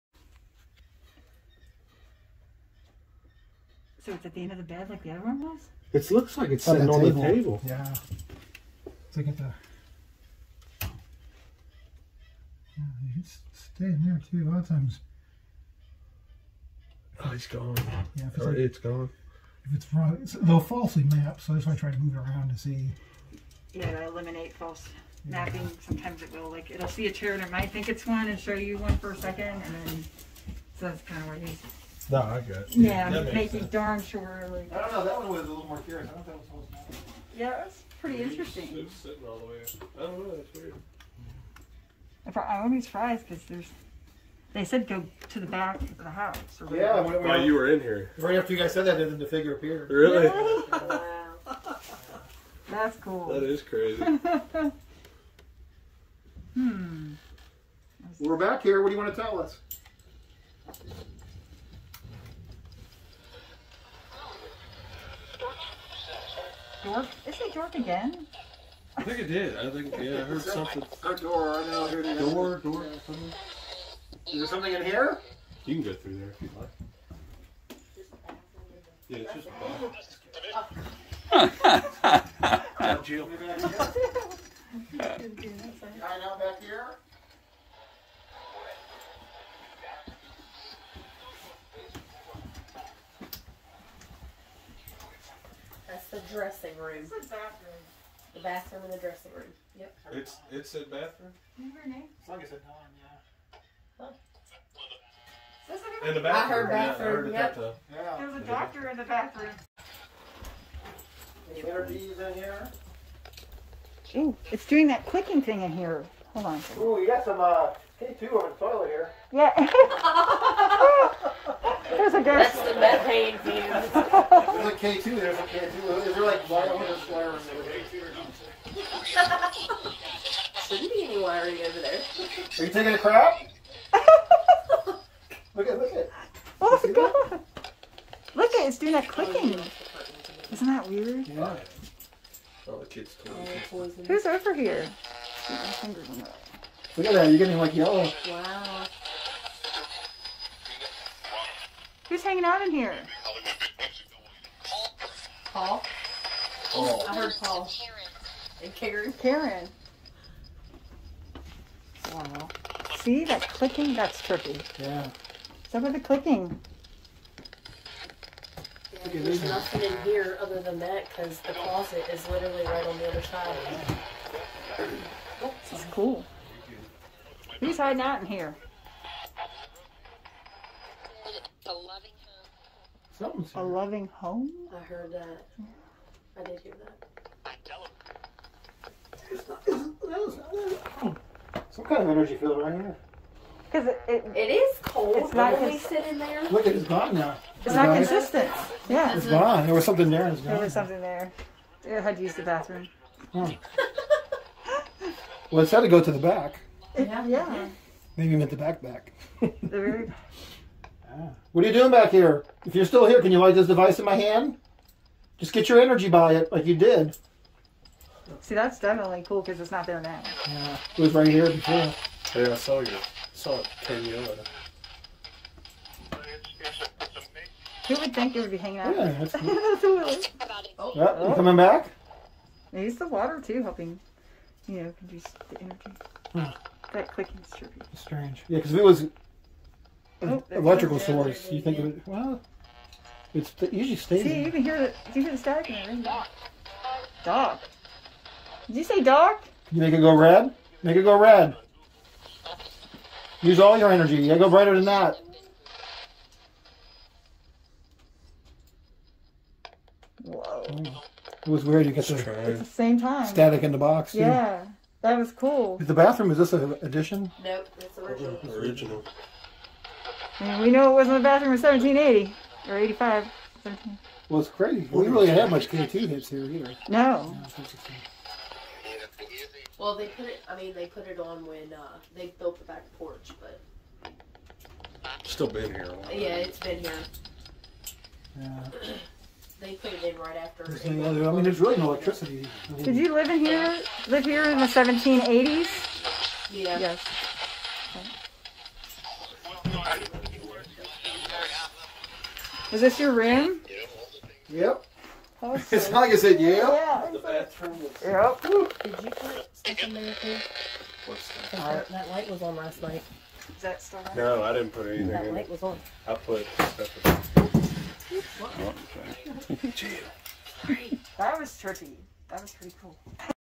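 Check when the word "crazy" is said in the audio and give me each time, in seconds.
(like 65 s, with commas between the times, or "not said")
53 s, 274 s.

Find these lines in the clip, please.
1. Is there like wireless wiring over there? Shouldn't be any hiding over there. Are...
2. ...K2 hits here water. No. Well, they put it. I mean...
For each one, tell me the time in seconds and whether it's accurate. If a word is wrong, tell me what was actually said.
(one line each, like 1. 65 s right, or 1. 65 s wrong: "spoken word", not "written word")
1. 126 s wrong: "wiring", not "hiding"
2. 275 s wrong: "either", not "water".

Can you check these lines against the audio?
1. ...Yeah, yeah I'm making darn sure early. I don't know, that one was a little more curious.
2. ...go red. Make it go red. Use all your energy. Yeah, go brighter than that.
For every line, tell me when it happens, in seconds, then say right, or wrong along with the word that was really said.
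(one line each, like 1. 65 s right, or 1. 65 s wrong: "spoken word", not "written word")
1. 32 s right
2. 250 s right.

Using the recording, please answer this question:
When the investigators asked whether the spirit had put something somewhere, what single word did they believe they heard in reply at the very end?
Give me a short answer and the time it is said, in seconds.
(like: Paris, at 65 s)
Jail, at 319 s.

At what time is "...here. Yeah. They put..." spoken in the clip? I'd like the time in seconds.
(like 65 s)
286 s.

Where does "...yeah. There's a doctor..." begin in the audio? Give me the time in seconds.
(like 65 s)
107 s.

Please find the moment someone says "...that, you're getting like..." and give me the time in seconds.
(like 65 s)
147 s.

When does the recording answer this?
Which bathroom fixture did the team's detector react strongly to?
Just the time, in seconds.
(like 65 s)
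118 s.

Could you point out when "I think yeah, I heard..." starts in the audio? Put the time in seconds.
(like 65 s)
69 s.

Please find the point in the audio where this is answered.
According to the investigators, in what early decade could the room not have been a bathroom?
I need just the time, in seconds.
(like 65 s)
271 s.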